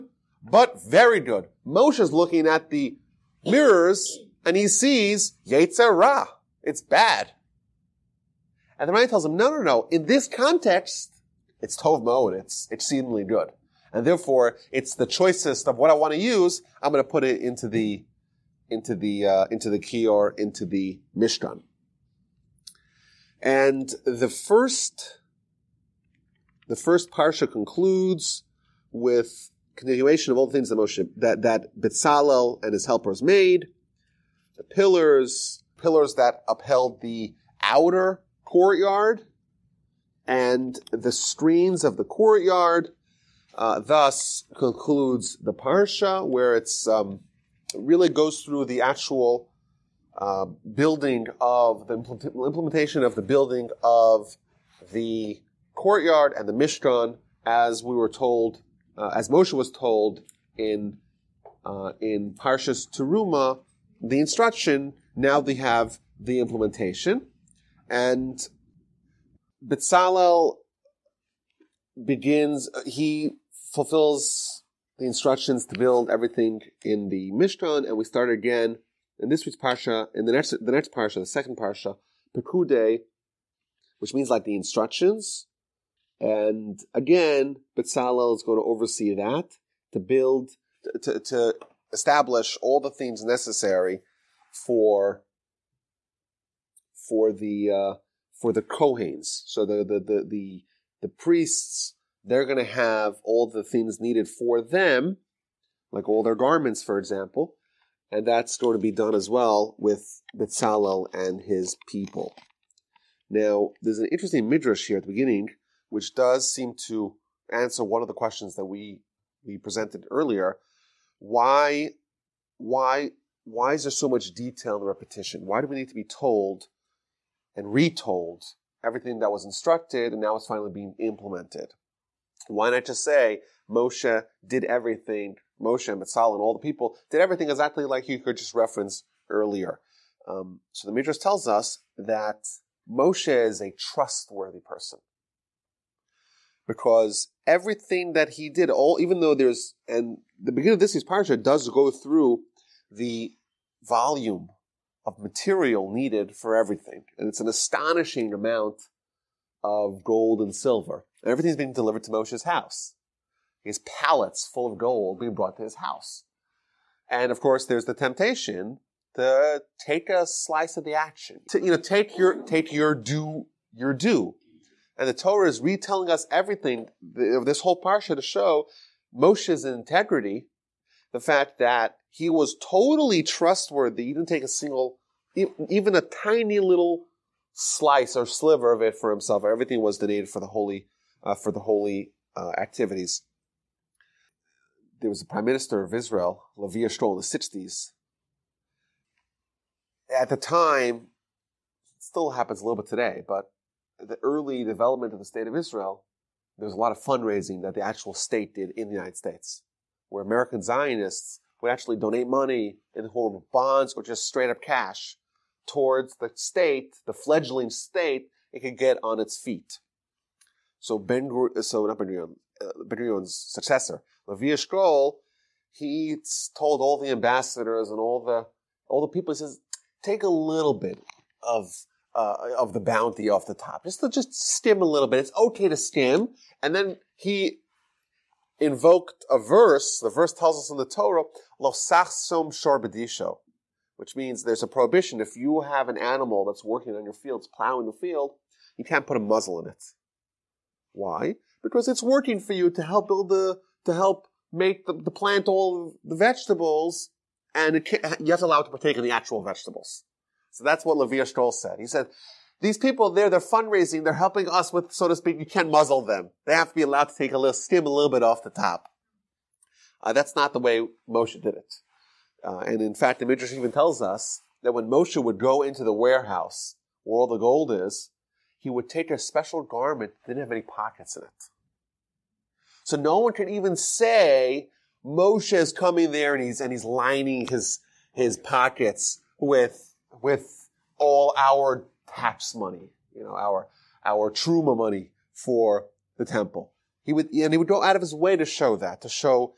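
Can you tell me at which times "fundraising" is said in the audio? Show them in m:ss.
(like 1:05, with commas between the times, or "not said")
3:27, 4:23.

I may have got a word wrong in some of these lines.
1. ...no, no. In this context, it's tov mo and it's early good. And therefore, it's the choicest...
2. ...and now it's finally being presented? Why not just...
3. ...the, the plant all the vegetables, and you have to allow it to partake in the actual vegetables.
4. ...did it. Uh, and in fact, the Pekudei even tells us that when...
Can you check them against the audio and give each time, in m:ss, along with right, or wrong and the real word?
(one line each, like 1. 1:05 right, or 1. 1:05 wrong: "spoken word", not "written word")
1. 0:09 wrong: "exceedingly", not "early"
2. 2:10 wrong: "implemented", not "presented"
3. 4:14 right
4. 4:31 wrong: "Midrash", not "Pekudei".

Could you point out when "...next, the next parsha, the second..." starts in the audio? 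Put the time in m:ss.
1:20.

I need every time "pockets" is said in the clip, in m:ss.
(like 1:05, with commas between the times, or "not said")
4:40, 4:48.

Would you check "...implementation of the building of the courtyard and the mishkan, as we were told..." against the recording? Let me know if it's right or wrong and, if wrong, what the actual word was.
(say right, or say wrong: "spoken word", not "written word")
right.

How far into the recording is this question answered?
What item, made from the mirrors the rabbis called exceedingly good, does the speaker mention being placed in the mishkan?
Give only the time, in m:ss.
0:19.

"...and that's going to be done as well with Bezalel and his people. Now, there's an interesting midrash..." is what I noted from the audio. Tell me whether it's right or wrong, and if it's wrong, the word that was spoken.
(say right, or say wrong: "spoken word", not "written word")
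right.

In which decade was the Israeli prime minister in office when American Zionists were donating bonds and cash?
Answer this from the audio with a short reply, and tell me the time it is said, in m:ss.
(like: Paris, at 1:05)
1960s, at 3:17.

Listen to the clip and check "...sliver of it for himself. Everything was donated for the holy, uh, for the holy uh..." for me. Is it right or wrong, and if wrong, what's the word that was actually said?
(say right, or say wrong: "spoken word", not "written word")
right.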